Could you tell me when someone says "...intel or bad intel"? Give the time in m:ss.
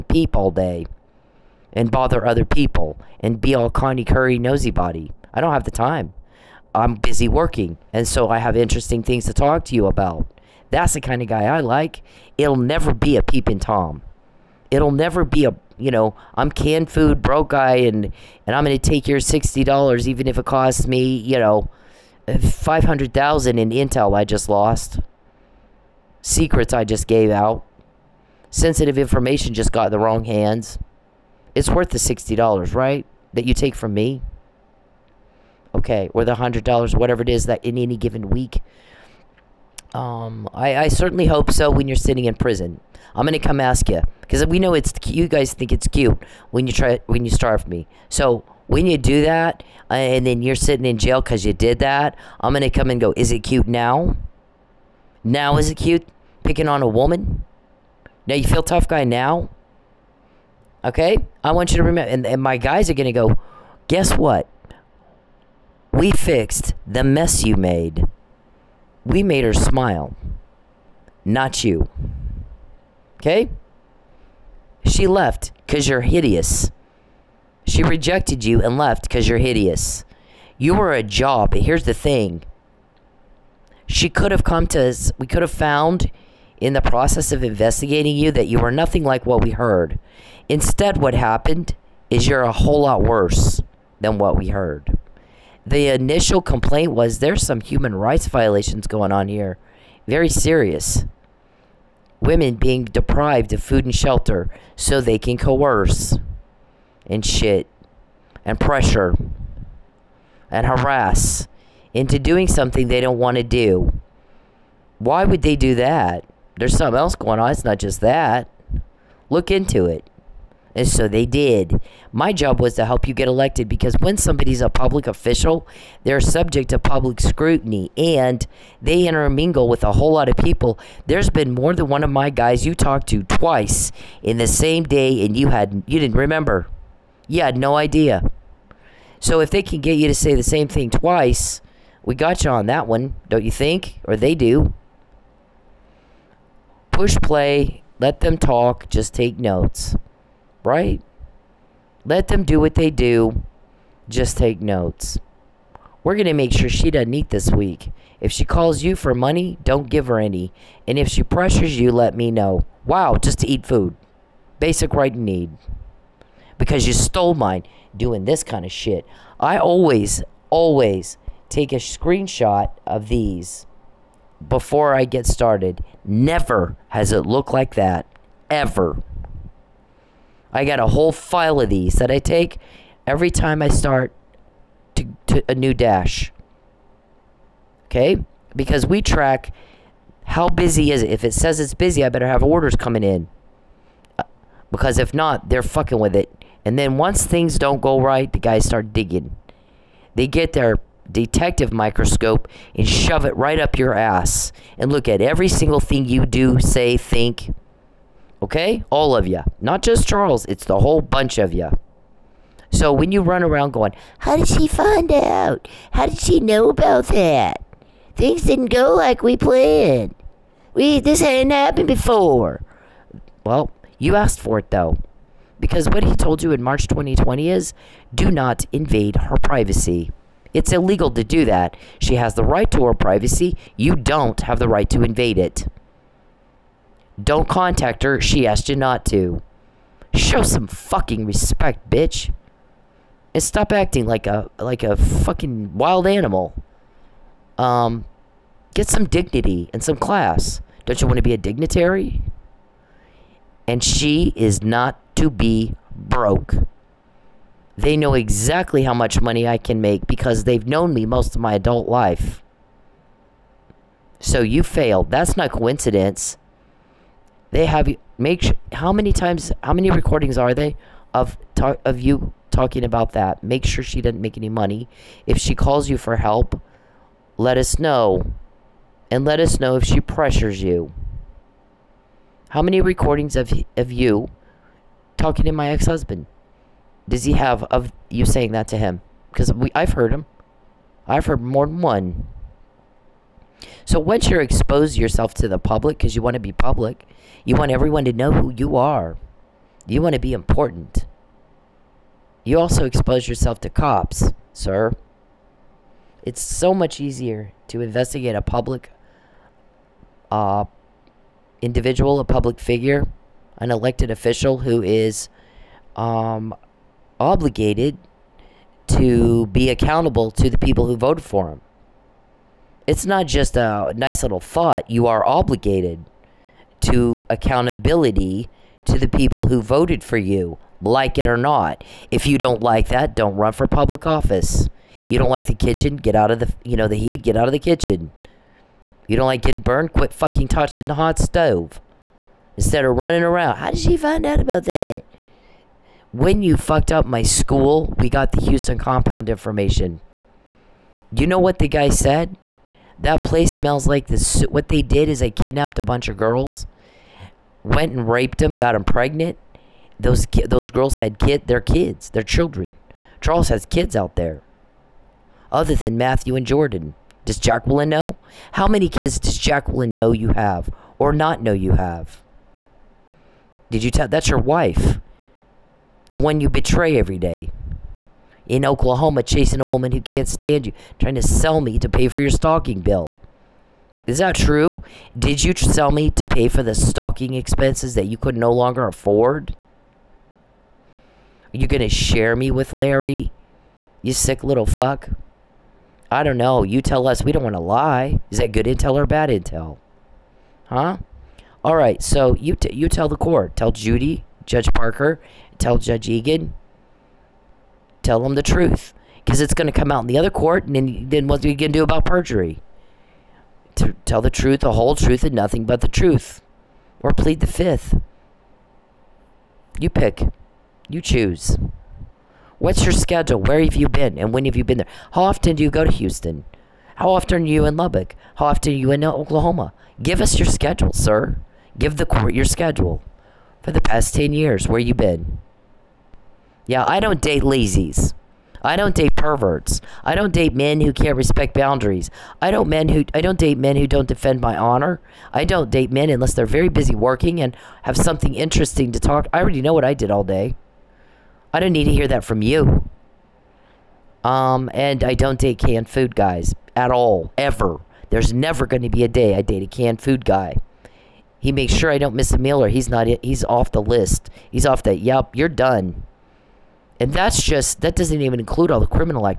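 6:38.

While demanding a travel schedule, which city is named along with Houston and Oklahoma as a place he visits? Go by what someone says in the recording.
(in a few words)
Lubbock.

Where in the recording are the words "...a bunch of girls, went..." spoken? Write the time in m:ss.
5:55.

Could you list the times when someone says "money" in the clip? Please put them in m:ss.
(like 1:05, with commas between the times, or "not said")
2:39, 4:19, 4:34.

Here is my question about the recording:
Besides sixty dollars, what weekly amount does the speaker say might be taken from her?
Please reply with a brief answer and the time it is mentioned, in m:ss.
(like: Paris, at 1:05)
$100, at 0:36.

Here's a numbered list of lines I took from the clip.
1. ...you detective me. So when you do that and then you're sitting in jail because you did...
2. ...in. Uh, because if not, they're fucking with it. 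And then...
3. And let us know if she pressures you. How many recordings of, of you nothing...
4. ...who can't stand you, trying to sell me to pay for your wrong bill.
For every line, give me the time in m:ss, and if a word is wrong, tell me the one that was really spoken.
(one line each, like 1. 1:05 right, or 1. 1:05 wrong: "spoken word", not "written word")
1. 0:47 wrong: "starve", not "detective"
2. 3:13 right
3. 4:39 wrong: "talking", not "nothing"
4. 6:19 wrong: "stalking", not "wrong".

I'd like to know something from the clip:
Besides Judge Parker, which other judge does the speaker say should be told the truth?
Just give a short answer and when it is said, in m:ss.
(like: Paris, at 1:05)
Judge Egan, at 6:45.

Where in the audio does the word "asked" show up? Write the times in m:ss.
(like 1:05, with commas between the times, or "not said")
3:44, 3:58.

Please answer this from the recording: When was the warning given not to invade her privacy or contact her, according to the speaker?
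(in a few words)
March 2020.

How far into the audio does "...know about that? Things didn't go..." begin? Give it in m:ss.
3:36.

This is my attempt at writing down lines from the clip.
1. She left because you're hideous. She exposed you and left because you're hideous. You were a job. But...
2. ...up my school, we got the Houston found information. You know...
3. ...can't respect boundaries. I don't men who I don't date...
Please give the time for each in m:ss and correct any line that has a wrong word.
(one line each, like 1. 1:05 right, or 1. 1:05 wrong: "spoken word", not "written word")
1. 1:14 wrong: "rejected", not "exposed"
2. 5:46 wrong: "compound", not "found"
3. 7:20 right.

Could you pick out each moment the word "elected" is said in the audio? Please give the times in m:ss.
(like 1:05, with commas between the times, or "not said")
2:03, 5:13.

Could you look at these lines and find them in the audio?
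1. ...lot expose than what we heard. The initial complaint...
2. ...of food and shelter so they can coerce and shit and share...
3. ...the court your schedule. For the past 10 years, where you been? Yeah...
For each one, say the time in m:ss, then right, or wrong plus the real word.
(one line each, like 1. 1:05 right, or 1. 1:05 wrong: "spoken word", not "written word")
1. 1:32 wrong: "worse", not "expose"
2. 1:43 wrong: "pressure", not "share"
3. 7:11 right.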